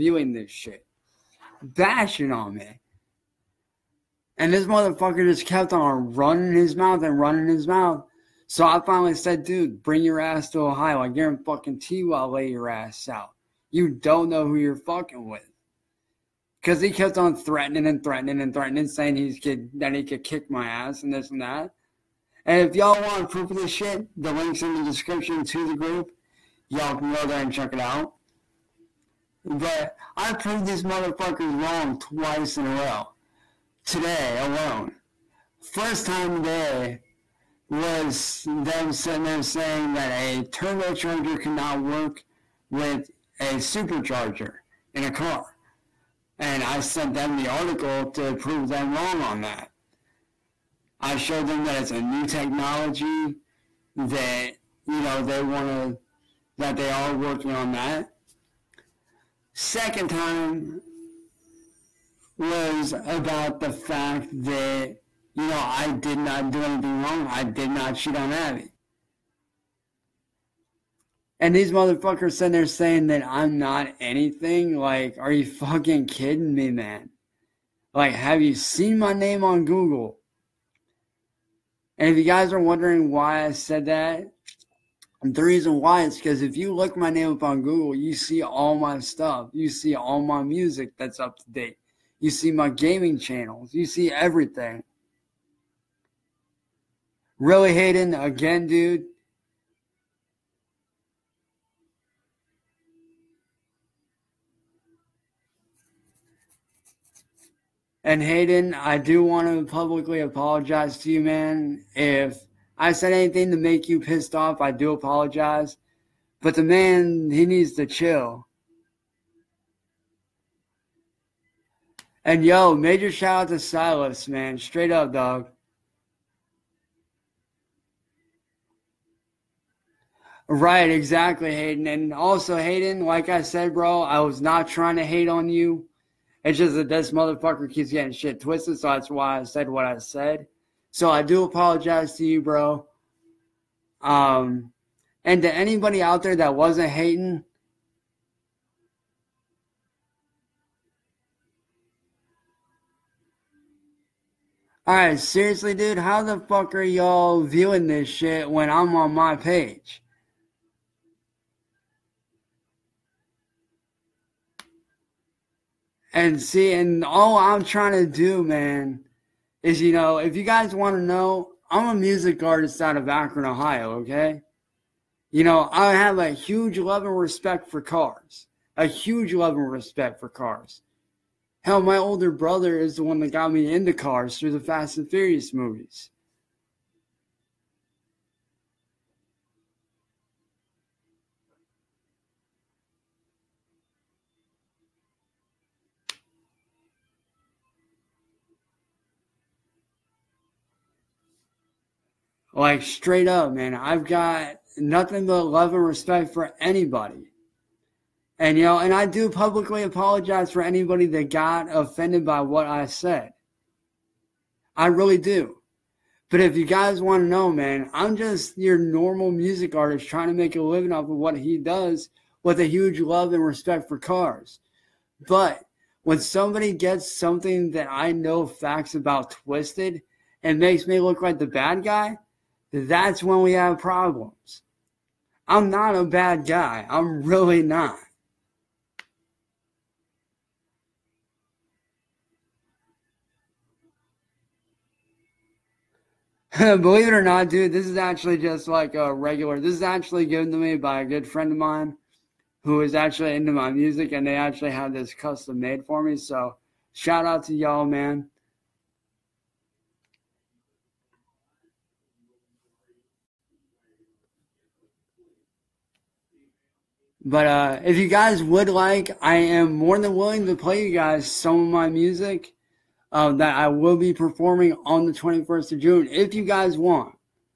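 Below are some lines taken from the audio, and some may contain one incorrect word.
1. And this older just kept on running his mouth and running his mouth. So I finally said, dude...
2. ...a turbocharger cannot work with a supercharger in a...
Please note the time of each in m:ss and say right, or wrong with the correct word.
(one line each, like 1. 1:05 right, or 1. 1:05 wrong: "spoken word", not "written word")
1. 0:04 wrong: "motherfucker", not "older"
2. 0:40 right.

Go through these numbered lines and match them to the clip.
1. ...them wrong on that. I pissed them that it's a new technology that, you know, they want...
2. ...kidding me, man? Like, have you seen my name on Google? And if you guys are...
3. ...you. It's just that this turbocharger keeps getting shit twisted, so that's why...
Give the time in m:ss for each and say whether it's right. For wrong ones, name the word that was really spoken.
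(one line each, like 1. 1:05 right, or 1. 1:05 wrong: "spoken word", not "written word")
1. 0:48 wrong: "showed", not "pissed"
2. 1:16 right
3. 2:15 wrong: "motherfucker", not "turbocharger".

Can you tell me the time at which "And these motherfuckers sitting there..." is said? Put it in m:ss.
1:11.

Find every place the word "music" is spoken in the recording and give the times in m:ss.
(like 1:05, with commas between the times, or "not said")
1:30, 2:51, 3:39, 4:13, 4:31.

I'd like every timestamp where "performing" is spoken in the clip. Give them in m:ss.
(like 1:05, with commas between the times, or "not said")
4:34.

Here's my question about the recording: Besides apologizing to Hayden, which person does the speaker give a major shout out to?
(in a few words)
Silas.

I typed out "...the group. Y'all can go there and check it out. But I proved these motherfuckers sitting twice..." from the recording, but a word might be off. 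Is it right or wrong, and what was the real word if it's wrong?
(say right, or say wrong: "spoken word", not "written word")
wrong: "wrong", not "sitting".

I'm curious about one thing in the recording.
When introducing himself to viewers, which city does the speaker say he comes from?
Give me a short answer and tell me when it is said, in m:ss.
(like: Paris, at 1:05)
Akron, at 2:53.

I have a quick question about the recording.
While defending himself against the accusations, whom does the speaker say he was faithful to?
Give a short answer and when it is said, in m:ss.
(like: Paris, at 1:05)
Abby, at 1:08.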